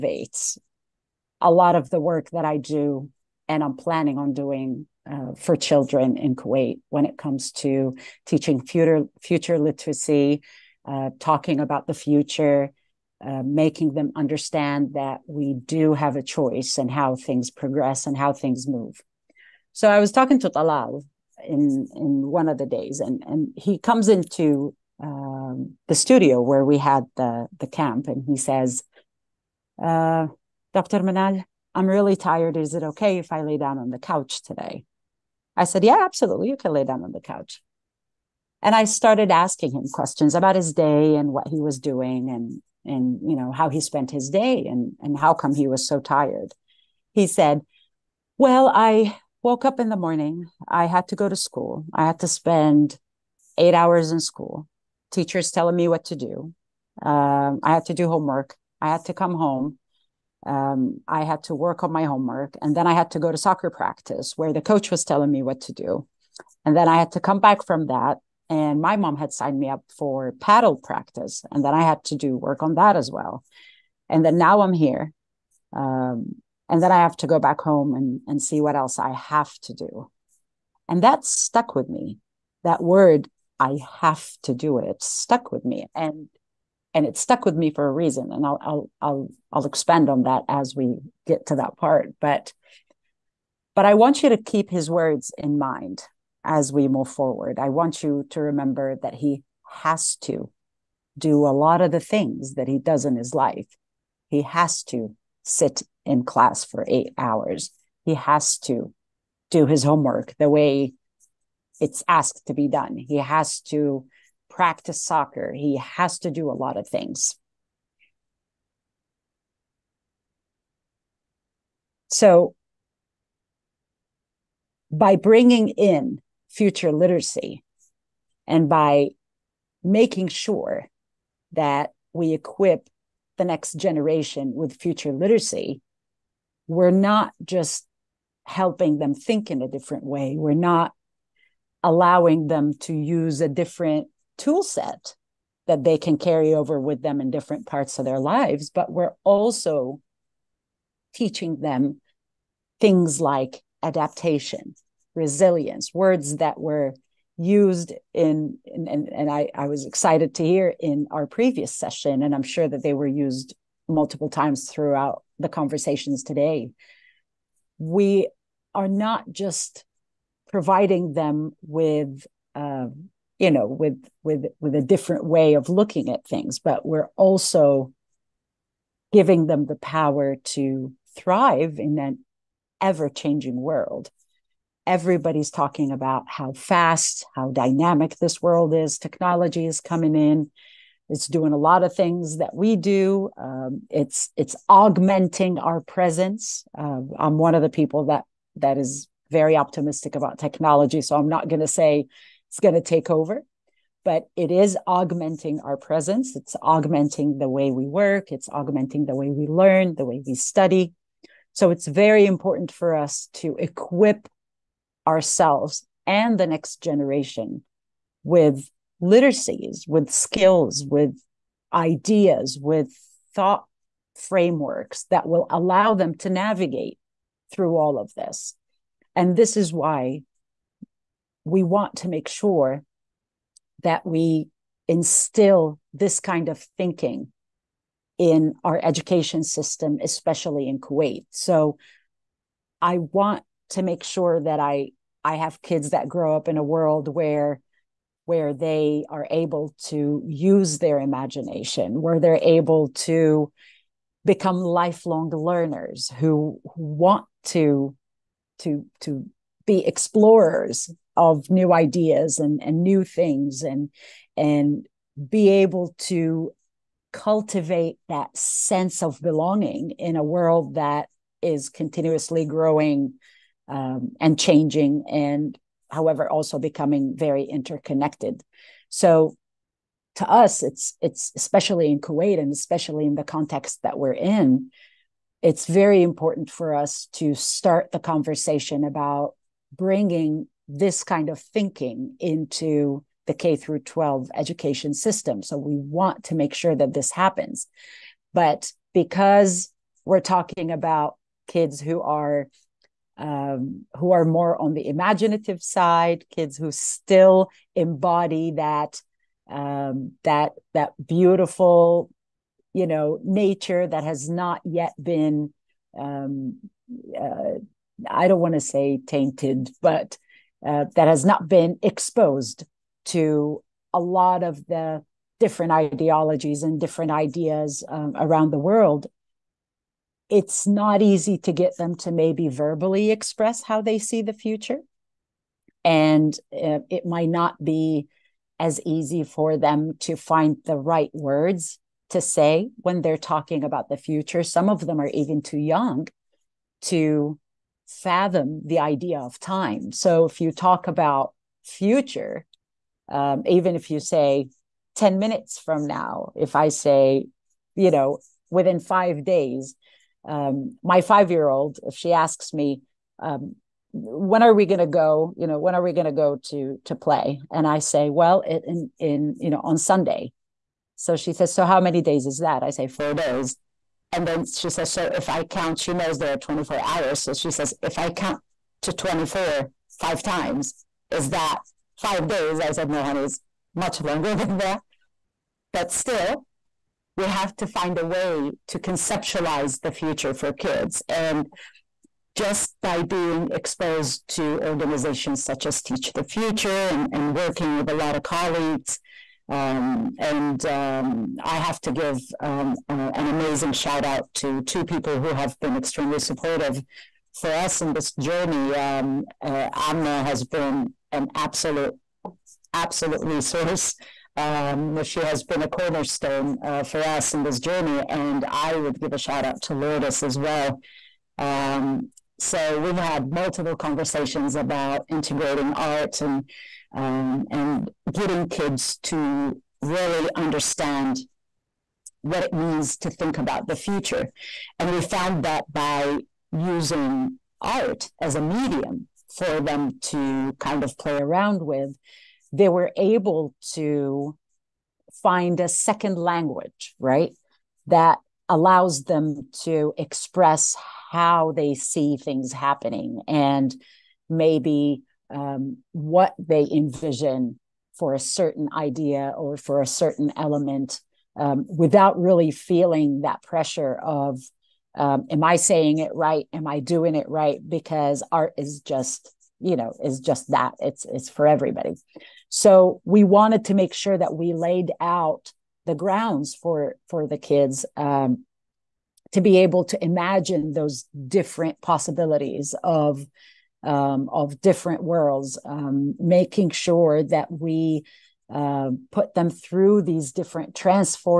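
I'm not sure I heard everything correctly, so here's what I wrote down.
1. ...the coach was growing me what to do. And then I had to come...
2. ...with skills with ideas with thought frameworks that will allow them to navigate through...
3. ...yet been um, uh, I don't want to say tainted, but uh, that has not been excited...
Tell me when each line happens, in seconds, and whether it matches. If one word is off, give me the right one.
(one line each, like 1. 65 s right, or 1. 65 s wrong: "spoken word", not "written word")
1. 64 s wrong: "telling", not "growing"
2. 219 s right
3. 314 s wrong: "exposed", not "excited".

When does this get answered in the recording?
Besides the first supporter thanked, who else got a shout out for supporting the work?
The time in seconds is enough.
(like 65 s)
419 s.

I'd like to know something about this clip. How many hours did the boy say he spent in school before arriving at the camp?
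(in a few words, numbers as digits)
8.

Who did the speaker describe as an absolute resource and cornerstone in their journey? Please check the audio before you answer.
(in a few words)
Amna.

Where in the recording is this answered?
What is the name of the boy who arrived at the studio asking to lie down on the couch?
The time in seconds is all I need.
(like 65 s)
20 s.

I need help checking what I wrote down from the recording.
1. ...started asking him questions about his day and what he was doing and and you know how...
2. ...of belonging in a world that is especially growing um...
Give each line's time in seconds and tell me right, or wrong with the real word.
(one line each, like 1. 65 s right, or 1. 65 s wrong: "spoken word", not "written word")
1. 38 s right
2. 269 s wrong: "continuously", not "especially".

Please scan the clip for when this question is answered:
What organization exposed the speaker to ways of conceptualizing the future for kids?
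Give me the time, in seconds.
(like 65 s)
395 s.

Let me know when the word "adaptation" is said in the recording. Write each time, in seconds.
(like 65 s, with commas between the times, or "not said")
153 s.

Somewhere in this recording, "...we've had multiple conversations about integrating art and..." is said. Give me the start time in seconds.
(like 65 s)
422 s.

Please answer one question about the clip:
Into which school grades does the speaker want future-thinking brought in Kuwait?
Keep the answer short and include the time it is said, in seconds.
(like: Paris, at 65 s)
K through 12, at 293 s.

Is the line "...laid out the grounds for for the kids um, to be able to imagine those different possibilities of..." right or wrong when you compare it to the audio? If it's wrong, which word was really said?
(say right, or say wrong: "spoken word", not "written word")
right.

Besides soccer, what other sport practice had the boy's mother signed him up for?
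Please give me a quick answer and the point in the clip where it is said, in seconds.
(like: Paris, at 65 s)
Paddle, at 70 s.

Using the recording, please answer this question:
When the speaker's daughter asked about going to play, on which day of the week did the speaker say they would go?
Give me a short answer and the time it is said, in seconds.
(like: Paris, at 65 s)
Sunday, at 369 s.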